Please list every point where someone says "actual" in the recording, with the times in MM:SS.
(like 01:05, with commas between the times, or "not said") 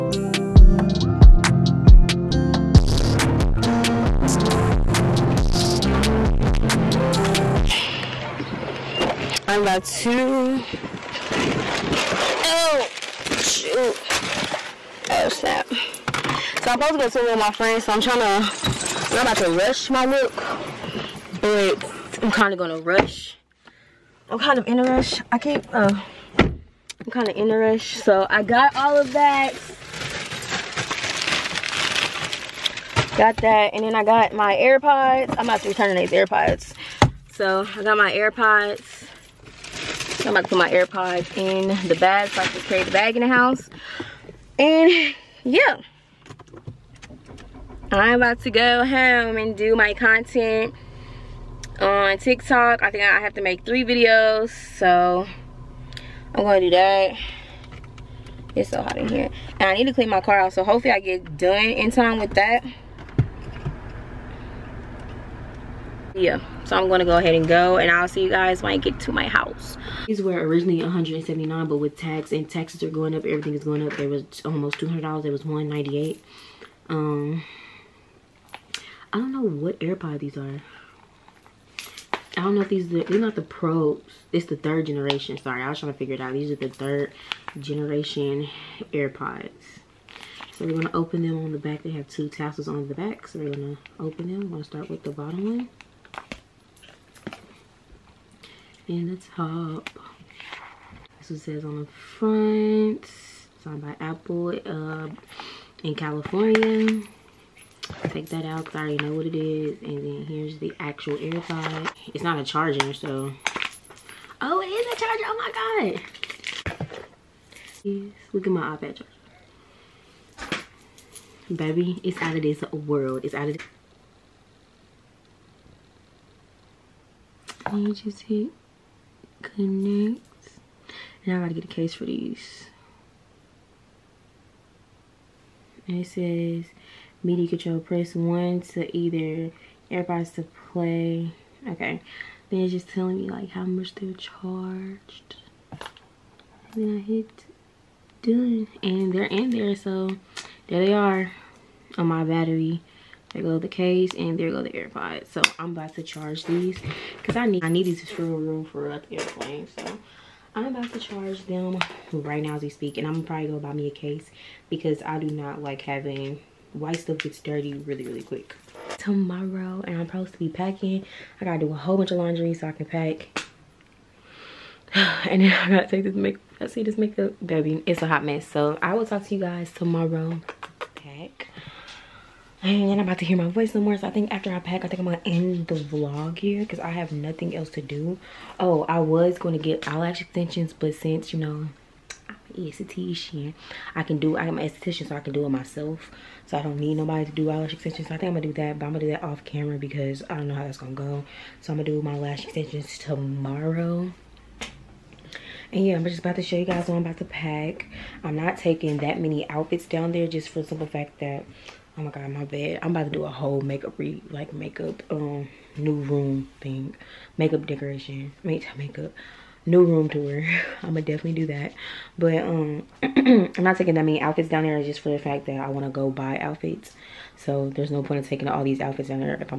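01:50.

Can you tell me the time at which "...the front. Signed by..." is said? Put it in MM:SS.
01:41.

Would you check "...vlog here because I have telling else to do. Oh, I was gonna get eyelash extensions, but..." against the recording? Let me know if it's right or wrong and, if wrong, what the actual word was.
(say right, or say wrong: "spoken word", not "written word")
wrong: "nothing", not "telling".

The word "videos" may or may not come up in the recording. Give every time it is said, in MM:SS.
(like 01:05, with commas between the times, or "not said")
00:53.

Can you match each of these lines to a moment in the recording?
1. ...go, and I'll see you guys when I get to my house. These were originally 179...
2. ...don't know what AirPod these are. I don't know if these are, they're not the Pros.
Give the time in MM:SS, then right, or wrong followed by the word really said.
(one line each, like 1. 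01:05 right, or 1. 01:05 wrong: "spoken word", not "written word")
1. 01:07 right
2. 01:19 right.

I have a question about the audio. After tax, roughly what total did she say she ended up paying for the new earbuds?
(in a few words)
$198.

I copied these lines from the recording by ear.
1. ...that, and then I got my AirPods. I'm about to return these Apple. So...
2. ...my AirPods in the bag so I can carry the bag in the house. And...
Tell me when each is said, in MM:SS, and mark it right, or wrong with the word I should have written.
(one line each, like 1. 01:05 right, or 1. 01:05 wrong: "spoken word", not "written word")
1. 00:33 wrong: "AirPods", not "Apple"
2. 00:40 right.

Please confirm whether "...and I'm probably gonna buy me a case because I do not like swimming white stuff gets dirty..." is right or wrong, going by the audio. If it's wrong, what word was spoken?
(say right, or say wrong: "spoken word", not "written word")
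wrong: "having", not "swimming".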